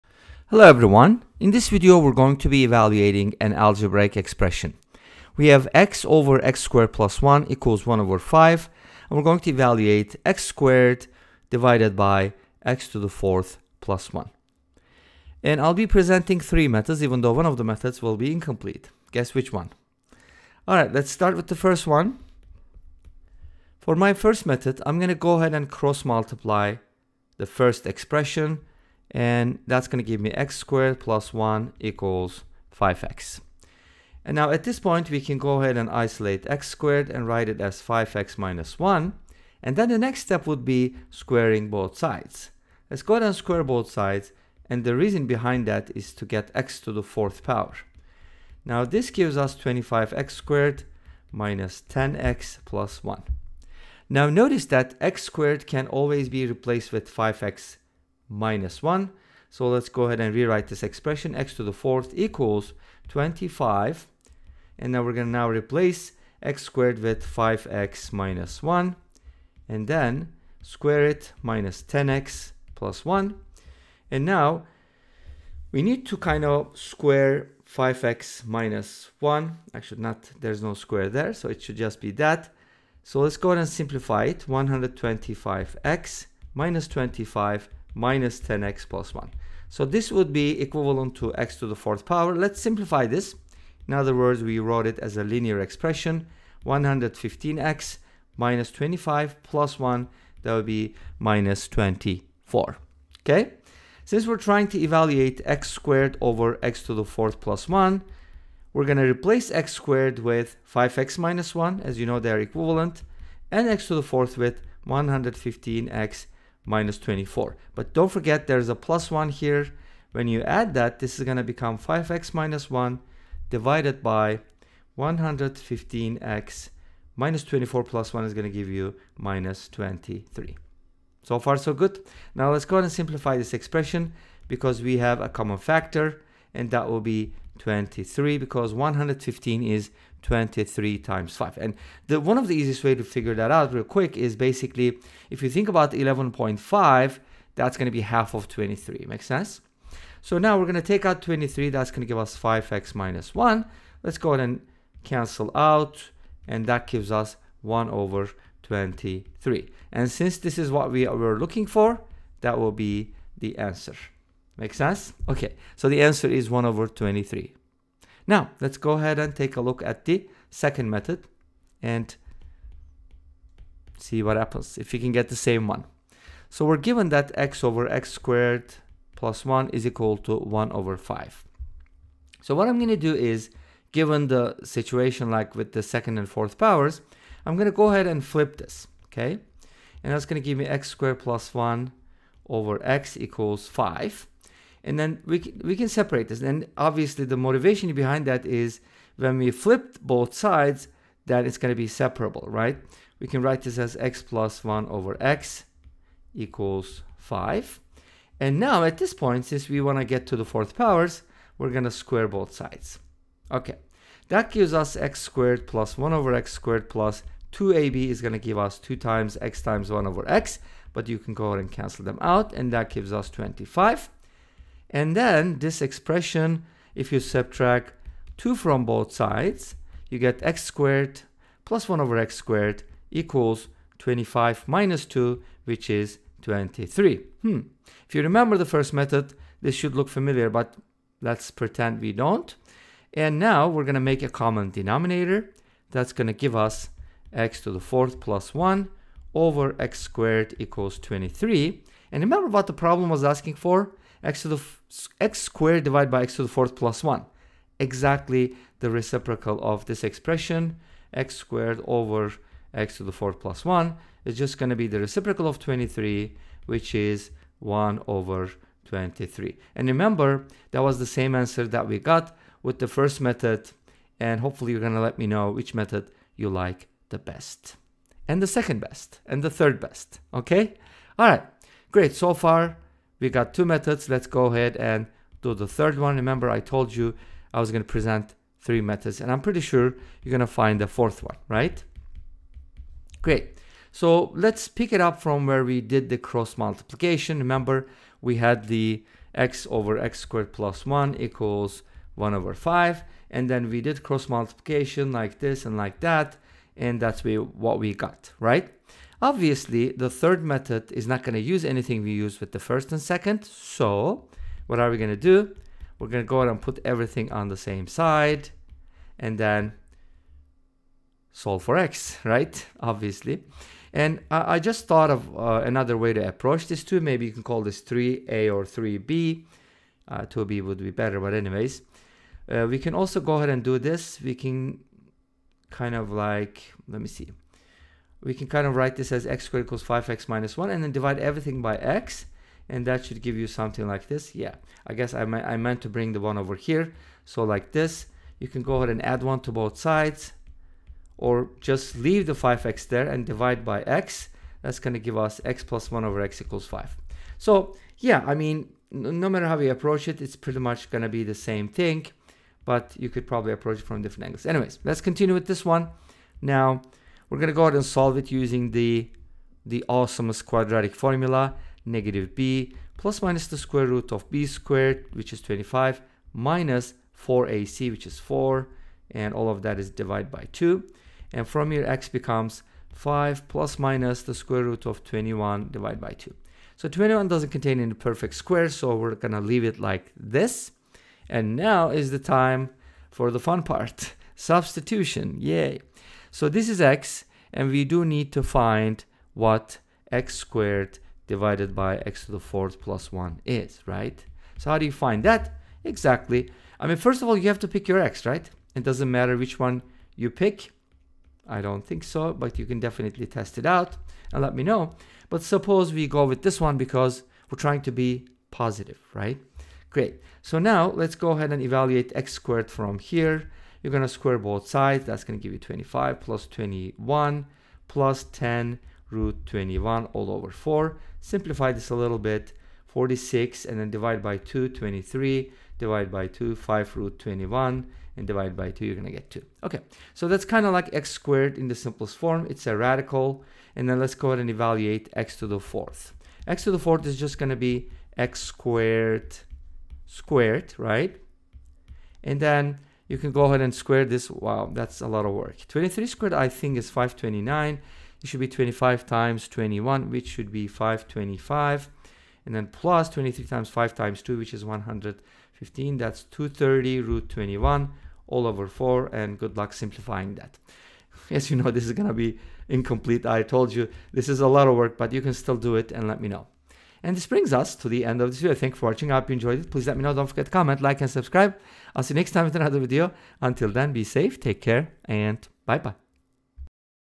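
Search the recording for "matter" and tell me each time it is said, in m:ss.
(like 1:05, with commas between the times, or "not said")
5:59, 6:49.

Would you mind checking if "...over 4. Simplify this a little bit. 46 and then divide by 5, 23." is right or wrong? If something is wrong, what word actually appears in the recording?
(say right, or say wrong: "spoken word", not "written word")
wrong: "2", not "5".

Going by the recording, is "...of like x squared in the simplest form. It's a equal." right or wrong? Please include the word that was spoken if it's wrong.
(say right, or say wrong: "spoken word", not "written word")
wrong: "radical", not "equal".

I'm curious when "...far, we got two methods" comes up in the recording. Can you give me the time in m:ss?
4:42.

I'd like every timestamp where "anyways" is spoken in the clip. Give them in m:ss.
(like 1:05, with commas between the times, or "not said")
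5:31, 6:04.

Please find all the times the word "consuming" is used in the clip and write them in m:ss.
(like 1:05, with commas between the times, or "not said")
not said.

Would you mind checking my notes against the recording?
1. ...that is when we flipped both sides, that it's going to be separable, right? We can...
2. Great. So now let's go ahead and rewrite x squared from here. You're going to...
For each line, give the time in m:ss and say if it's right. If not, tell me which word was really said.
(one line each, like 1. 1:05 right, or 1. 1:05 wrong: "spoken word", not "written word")
1. 3:18 right
2. 6:59 wrong: "evaluate", not "rewrite".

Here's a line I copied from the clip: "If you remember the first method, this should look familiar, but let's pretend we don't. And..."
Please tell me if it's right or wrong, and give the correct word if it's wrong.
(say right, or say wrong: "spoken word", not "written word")
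right.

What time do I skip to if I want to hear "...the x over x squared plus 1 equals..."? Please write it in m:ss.
4:58.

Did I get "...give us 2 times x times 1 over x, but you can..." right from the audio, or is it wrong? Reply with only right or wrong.
right.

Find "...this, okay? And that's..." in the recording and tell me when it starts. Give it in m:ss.
3:08.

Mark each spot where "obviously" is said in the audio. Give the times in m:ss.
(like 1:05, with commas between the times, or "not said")
3:16, 5:09, 5:22.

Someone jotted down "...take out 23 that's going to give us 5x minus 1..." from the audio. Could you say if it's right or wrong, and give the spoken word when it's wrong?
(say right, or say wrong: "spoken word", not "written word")
right.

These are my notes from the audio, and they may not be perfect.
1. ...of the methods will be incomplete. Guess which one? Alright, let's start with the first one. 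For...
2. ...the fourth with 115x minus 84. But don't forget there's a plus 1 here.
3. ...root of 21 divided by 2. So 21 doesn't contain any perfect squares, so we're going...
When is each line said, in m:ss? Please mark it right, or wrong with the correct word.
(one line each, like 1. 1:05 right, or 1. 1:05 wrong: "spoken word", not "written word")
1. 0:17 right
2. 1:53 wrong: "24", not "84"
3. 6:24 right.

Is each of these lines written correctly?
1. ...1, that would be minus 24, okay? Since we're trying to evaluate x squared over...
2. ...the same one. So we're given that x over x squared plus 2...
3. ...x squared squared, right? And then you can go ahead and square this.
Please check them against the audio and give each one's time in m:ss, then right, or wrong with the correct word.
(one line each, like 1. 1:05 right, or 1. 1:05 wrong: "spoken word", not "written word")
1. 1:39 right
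2. 2:55 wrong: "1", not "2"
3. 7:28 right.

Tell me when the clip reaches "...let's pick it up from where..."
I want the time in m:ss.
4:54.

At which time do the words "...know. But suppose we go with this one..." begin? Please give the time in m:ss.
6:54.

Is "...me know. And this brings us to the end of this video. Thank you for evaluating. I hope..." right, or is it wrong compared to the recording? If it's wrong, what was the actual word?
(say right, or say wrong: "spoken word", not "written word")
wrong: "watching", not "evaluating".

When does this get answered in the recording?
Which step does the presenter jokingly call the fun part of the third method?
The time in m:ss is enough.
6:34.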